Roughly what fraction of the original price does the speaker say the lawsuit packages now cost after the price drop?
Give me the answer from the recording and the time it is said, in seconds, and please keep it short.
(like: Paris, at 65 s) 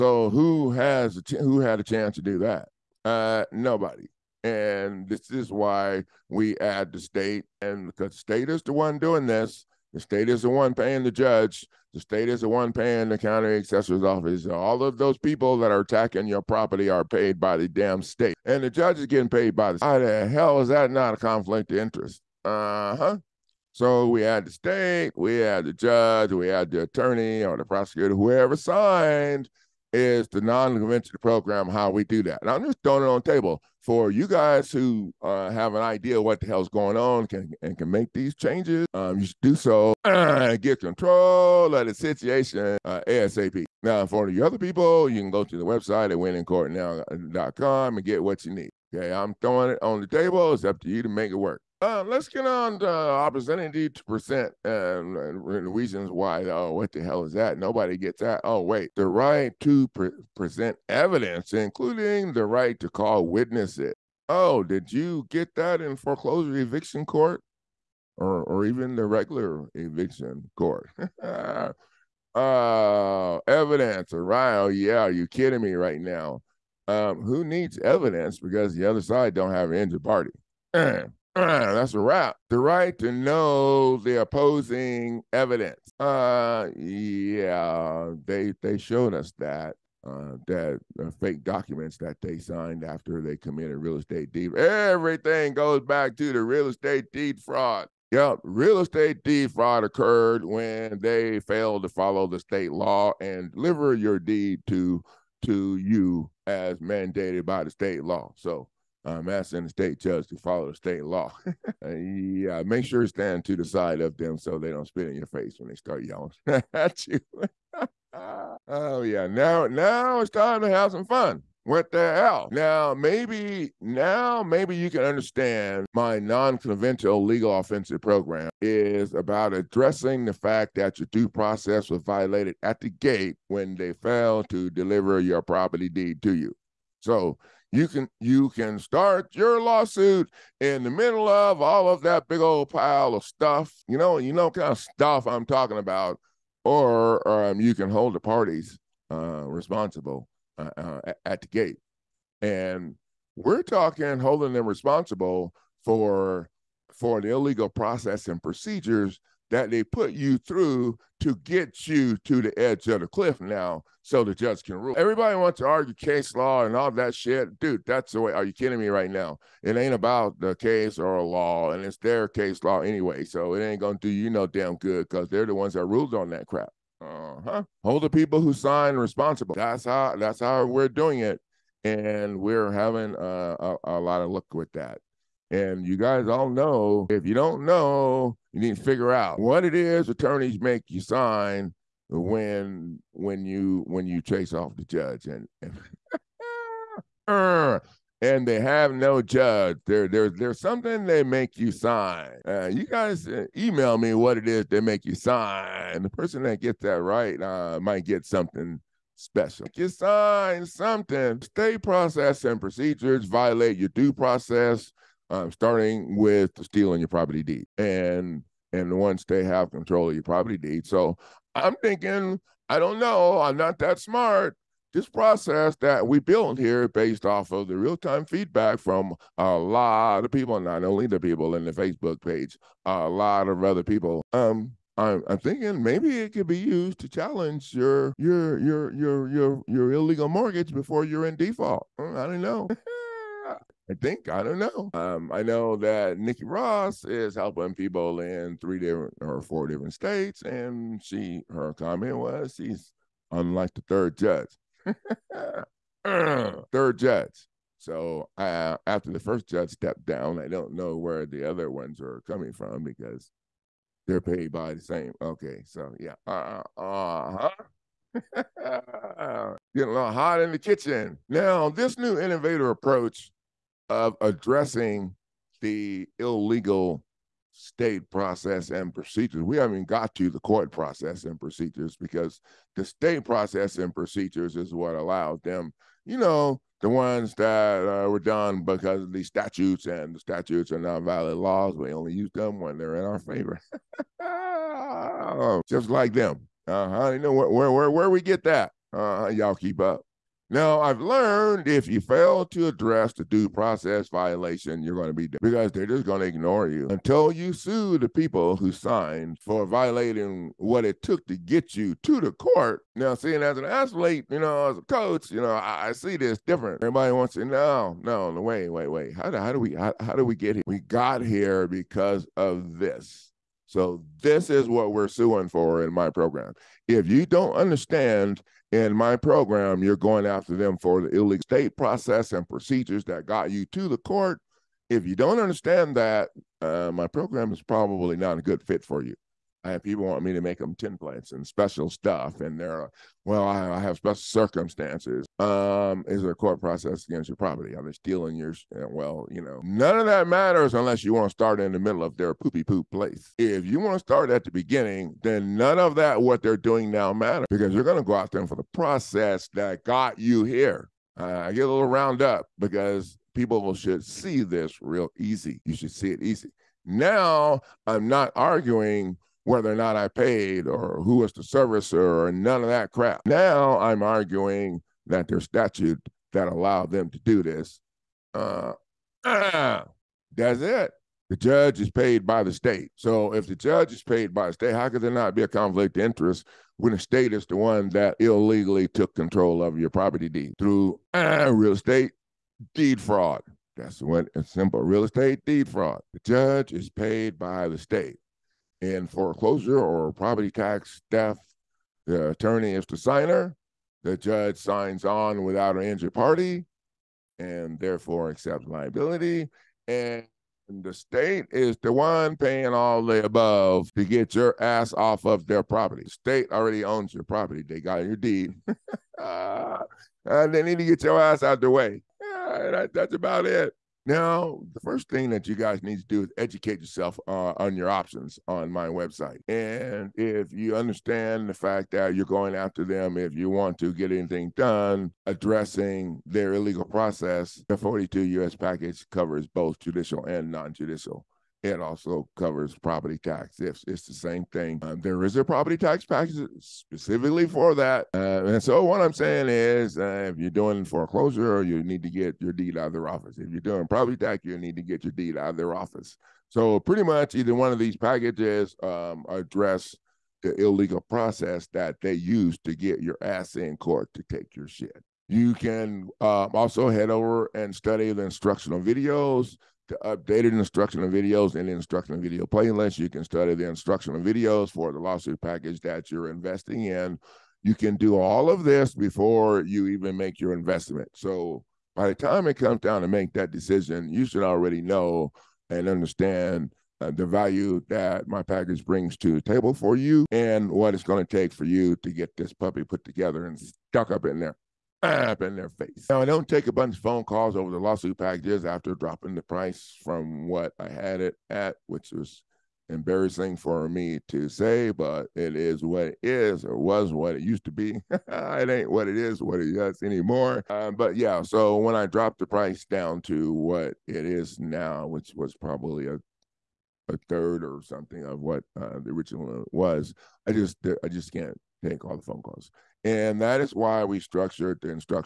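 a third, at 517 s.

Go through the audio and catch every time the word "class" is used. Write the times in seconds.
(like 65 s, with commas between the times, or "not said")
not said.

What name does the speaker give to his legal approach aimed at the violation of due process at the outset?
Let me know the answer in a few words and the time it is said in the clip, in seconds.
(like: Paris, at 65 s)
non-conventional legal offensive program, at 126 s.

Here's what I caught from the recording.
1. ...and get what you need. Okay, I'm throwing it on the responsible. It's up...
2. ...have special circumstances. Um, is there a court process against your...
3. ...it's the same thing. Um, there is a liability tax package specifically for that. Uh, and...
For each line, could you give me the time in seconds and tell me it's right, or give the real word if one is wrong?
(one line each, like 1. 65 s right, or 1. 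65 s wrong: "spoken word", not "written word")
1. 47 s wrong: "table", not "responsible"
2. 343 s right
3. 443 s wrong: "property", not "liability".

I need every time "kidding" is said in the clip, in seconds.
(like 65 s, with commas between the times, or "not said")
75 s, 168 s.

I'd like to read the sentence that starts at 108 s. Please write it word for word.
So um, asking the state judge to follow the state law.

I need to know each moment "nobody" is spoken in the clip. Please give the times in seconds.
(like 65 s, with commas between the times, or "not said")
3 s, 57 s.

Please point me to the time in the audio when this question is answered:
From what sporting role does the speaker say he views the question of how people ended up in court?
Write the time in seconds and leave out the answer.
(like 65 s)
314 s.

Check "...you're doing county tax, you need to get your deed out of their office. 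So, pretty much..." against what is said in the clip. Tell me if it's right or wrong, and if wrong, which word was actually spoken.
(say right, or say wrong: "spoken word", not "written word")
wrong: "property", not "county".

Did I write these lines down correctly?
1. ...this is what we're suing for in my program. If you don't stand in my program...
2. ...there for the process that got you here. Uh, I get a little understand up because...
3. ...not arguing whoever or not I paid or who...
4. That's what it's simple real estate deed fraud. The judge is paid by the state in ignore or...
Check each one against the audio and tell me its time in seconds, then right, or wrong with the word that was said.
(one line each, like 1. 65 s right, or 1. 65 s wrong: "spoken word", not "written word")
1. 324 s wrong: "understand", not "stand"
2. 358 s wrong: "round", not "understand"
3. 368 s wrong: "whether", not "whoever"
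4. 393 s wrong: "foreclosure", not "ignore".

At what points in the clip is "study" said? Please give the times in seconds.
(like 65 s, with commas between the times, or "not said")
467 s, 473 s.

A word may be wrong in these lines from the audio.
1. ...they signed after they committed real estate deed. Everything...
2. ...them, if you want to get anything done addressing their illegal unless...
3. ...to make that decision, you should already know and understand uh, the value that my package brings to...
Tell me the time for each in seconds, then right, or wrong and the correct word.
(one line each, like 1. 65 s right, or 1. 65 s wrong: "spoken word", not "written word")
1. 92 s right
2. 432 s wrong: "process", not "unless"
3. 483 s right.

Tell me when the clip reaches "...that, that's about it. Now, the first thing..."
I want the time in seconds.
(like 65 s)
422 s.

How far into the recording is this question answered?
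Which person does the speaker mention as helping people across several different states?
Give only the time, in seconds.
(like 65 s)
246 s.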